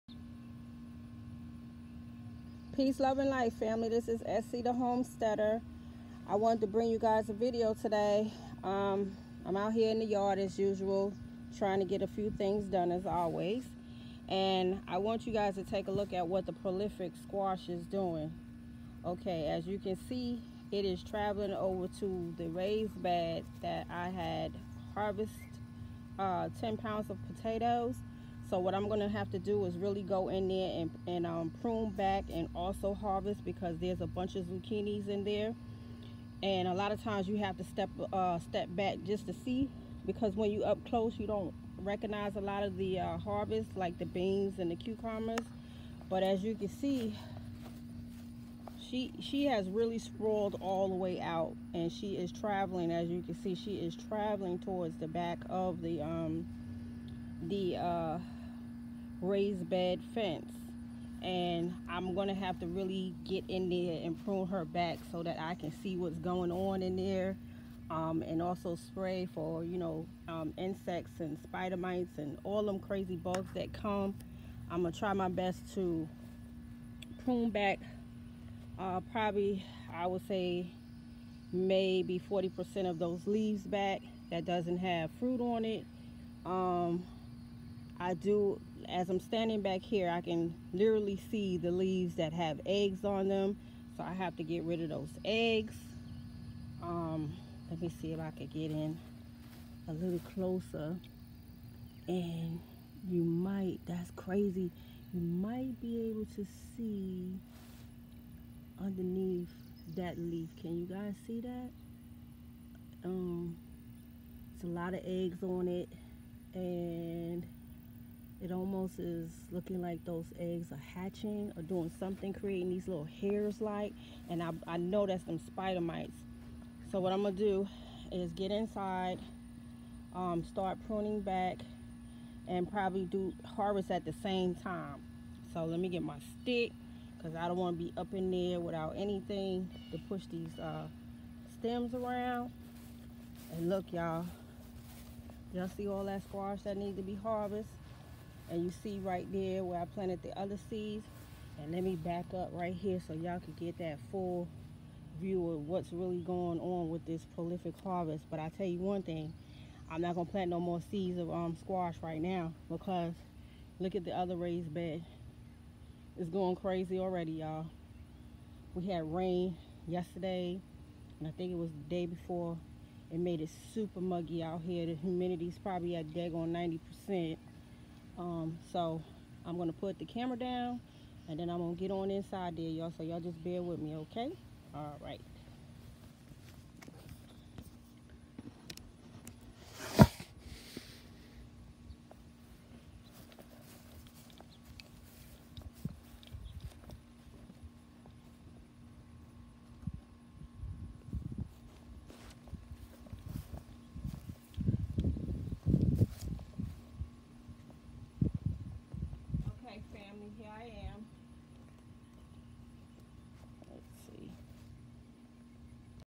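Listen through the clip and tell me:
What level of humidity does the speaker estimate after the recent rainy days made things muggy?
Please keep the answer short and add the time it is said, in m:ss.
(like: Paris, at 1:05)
90 percent, at 2:56.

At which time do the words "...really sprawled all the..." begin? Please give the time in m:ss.
0:49.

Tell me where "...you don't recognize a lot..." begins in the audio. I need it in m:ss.
0:41.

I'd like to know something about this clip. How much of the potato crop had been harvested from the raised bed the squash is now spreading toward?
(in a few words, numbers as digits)
10 pounds.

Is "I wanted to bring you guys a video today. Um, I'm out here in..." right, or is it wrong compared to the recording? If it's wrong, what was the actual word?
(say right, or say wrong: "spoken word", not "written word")
right.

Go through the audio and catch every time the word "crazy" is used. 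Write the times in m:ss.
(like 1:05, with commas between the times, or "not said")
1:12, 1:44, 2:46.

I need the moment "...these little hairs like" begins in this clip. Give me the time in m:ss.
2:02.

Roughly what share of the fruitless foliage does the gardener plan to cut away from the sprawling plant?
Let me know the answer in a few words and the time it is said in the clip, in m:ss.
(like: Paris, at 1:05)
40%, at 1:22.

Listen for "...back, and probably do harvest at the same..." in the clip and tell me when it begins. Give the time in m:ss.
2:11.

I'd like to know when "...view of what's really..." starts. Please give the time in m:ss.
2:35.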